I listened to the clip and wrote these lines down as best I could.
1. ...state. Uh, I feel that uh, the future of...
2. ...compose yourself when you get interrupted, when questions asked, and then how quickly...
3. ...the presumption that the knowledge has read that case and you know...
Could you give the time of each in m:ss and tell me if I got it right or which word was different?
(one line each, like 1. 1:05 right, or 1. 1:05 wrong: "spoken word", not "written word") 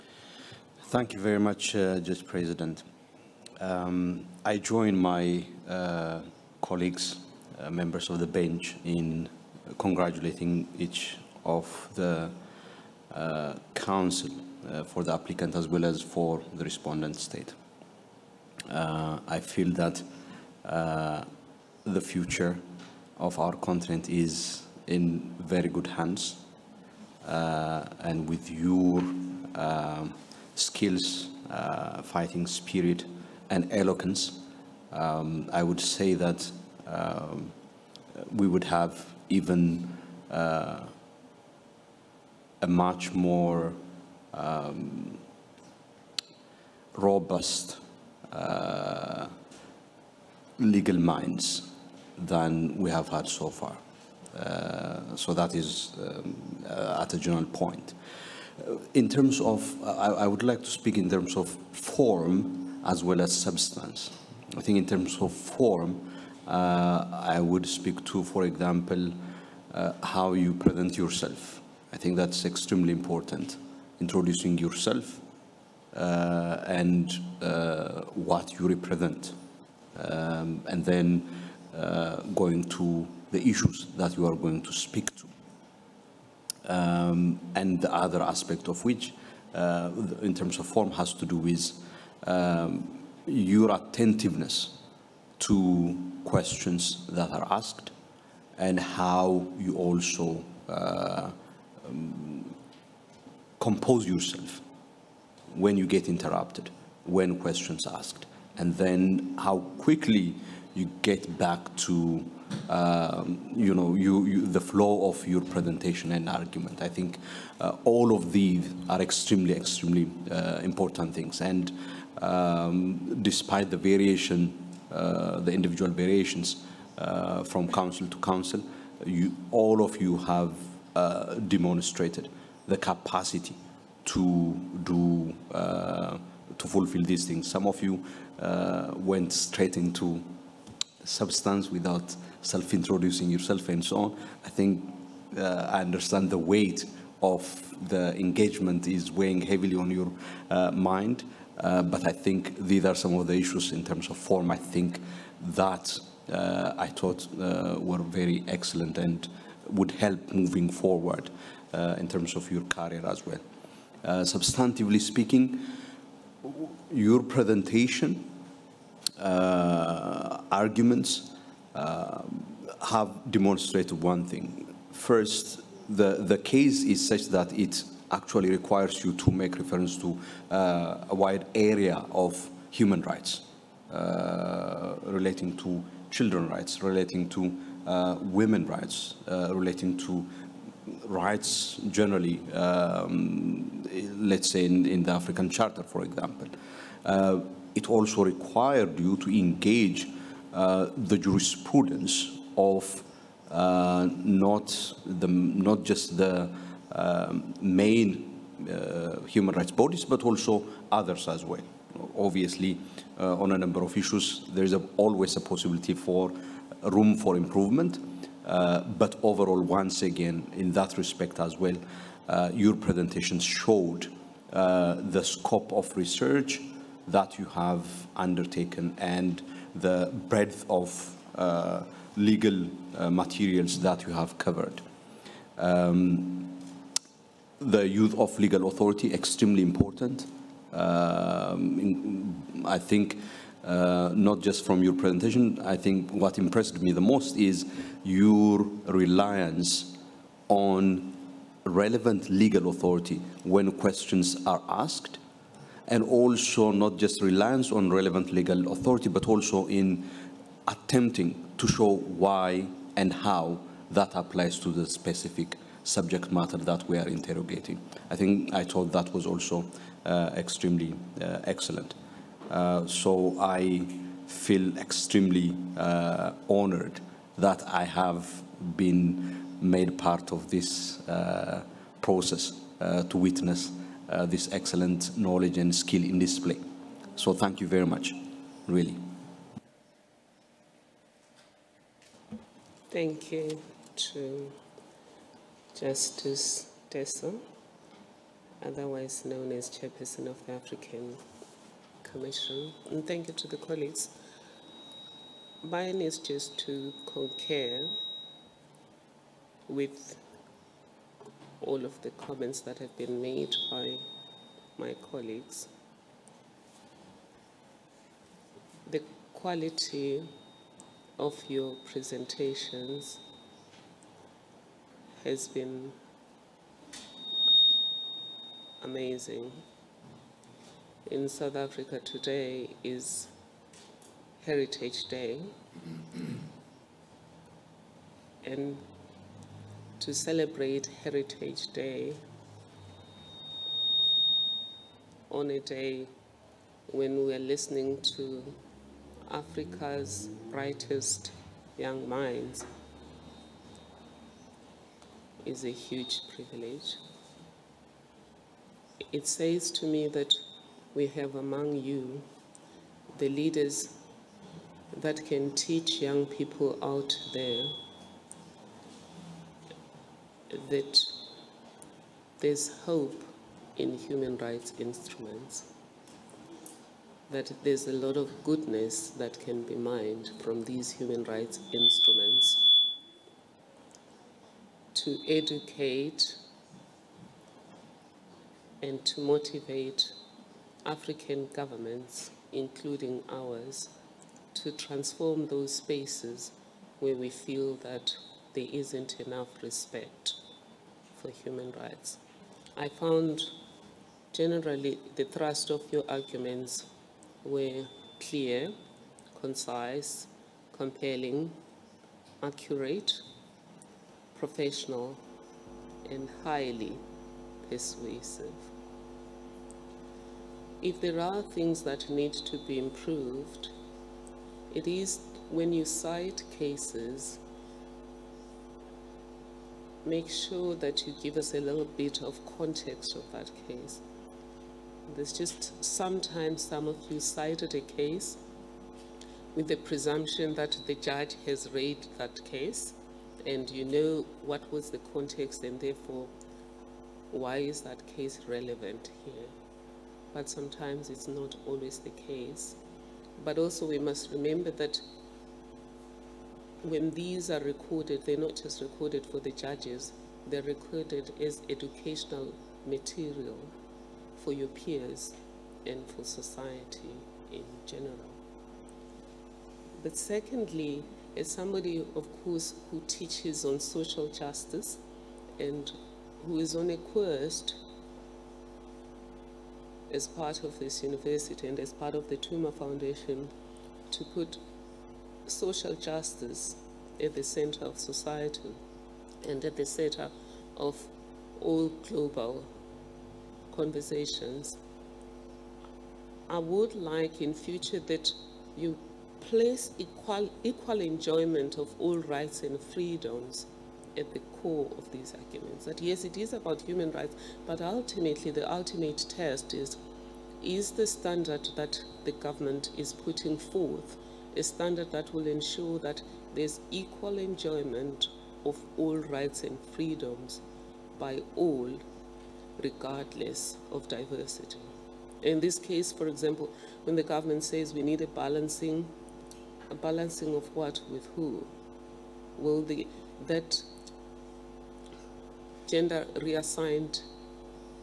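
1. 0:17 right
2. 1:43 right
3. 7:19 wrong: "judge", not "knowledge".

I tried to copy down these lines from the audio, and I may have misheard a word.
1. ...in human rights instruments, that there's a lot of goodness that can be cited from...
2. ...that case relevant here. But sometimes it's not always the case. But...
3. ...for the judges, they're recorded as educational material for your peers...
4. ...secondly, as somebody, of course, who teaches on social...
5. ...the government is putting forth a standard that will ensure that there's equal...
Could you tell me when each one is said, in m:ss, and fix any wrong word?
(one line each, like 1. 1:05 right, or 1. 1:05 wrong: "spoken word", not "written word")
1. 6:13 wrong: "mined", not "cited"
2. 7:27 right
3. 7:39 right
4. 7:50 right
5. 8:32 right.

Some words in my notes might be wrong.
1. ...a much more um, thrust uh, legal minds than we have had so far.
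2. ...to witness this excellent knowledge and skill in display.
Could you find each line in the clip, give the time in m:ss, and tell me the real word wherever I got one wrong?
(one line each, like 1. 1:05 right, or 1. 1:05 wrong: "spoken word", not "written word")
1. 0:42 wrong: "robust", not "thrust"
2. 4:42 right.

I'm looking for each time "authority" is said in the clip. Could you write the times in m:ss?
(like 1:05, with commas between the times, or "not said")
3:58, 4:12, 4:18.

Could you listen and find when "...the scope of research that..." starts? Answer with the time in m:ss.
3:44.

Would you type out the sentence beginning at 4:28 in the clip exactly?
I think I thought that was also uh, extremely uh, excellent.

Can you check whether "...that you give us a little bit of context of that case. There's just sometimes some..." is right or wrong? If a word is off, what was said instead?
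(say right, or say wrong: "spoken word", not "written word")
right.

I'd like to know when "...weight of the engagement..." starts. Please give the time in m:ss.
2:26.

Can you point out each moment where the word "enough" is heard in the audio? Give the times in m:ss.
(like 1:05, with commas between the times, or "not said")
6:39.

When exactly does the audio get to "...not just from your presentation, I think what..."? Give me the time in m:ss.
4:04.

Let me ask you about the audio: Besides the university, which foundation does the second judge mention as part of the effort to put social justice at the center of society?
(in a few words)
Thuma Foundation.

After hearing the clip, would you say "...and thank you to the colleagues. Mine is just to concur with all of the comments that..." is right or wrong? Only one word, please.
right.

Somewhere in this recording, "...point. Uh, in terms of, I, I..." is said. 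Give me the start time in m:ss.
0:57.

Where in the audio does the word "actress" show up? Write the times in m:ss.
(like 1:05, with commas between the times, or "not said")
not said.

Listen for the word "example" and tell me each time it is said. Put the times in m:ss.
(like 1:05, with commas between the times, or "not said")
1:08, 3:16, 8:46.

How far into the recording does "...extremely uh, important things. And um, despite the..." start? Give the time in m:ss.
1:59.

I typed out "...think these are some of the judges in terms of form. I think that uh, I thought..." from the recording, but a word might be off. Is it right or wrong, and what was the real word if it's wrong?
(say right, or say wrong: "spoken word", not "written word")
wrong: "issues", not "judges".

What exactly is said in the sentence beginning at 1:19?
Um, and then uh, going to the issues that you are going to speak to.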